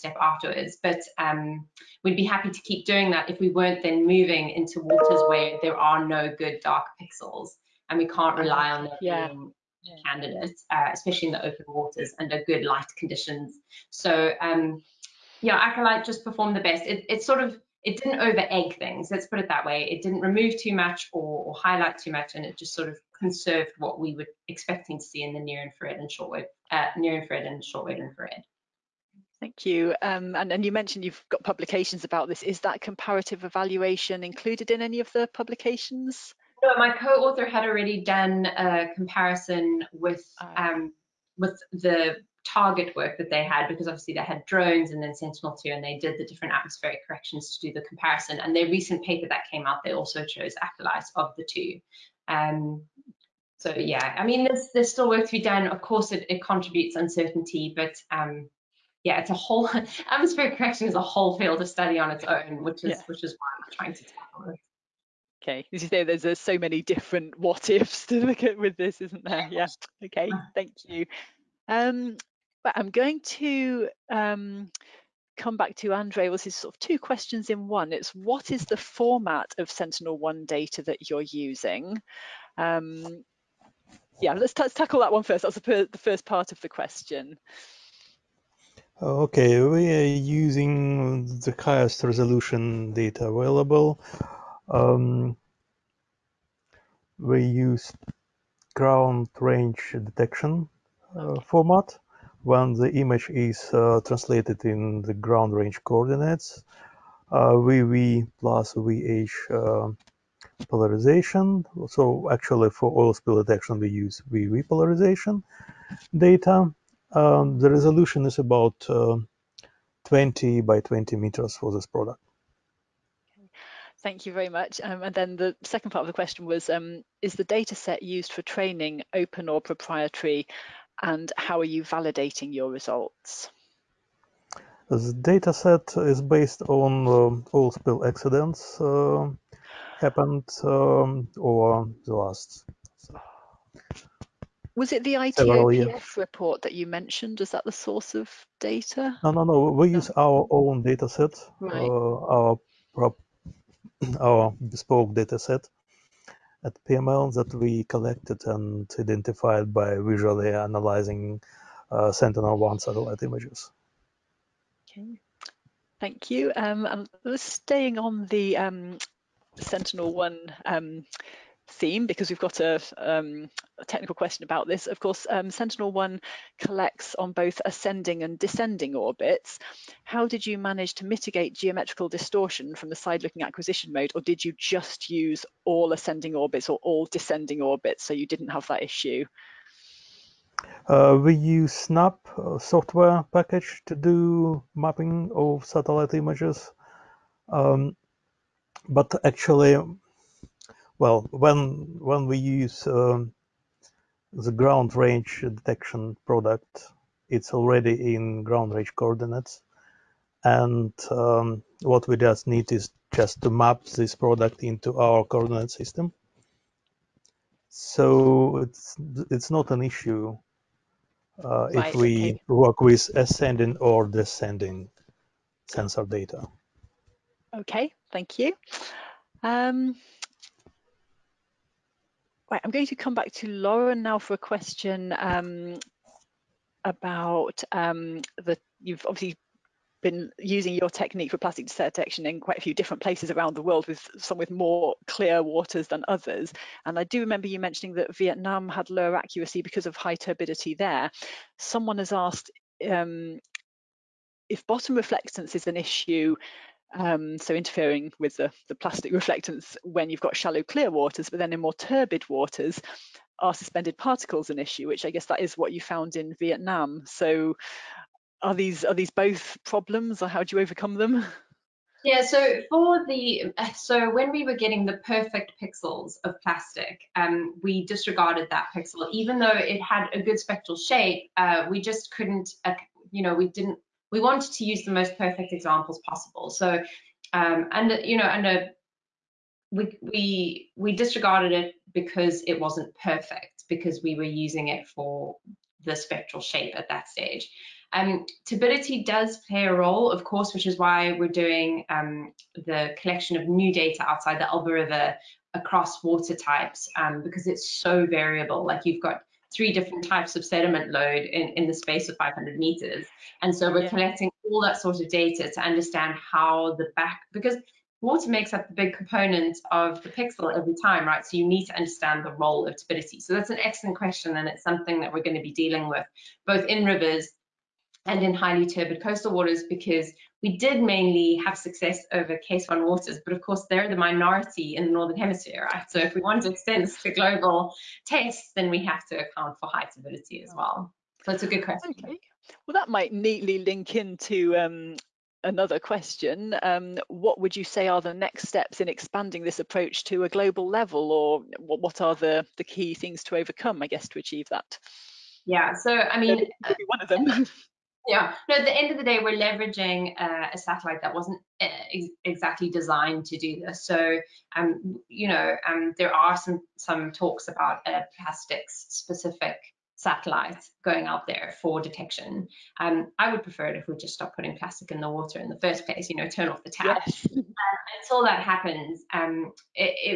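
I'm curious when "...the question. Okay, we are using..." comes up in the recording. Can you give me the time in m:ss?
1:26.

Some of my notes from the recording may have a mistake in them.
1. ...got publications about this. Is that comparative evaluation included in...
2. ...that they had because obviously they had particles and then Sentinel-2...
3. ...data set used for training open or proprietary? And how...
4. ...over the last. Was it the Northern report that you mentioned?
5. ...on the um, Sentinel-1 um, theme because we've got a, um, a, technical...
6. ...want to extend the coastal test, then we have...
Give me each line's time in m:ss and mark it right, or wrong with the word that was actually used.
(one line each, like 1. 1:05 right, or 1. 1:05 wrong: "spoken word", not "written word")
1. 0:31 right
2. 0:43 wrong: "drones", not "particles"
3. 2:07 right
4. 2:21 wrong: "ITOPF", not "Northern"
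5. 2:47 right
6. 5:36 wrong: "global", not "coastal".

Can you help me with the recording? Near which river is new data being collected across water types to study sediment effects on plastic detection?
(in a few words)
Elbe River.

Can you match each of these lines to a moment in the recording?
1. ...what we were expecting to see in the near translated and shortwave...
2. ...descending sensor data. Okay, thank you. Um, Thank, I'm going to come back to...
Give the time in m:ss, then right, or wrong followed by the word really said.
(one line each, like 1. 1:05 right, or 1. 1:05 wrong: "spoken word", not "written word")
1. 0:23 wrong: "infrared", not "translated"
2. 3:44 wrong: "Right", not "Thank".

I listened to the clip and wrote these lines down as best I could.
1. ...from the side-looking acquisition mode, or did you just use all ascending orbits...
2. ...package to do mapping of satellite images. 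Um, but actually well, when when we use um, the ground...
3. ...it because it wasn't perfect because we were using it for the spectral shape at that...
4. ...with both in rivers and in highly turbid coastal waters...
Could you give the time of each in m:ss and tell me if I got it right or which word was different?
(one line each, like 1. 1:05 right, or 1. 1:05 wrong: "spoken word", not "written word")
1. 3:02 right
2. 3:13 right
3. 4:51 right
4. 5:25 right.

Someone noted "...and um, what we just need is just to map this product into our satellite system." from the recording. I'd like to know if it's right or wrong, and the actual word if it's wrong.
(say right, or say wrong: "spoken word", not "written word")
wrong: "coordinate", not "satellite".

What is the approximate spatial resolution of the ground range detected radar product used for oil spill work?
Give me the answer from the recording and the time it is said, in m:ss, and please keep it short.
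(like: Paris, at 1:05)
20 by 20 meters, at 2:00.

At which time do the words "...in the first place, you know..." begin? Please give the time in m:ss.
6:15.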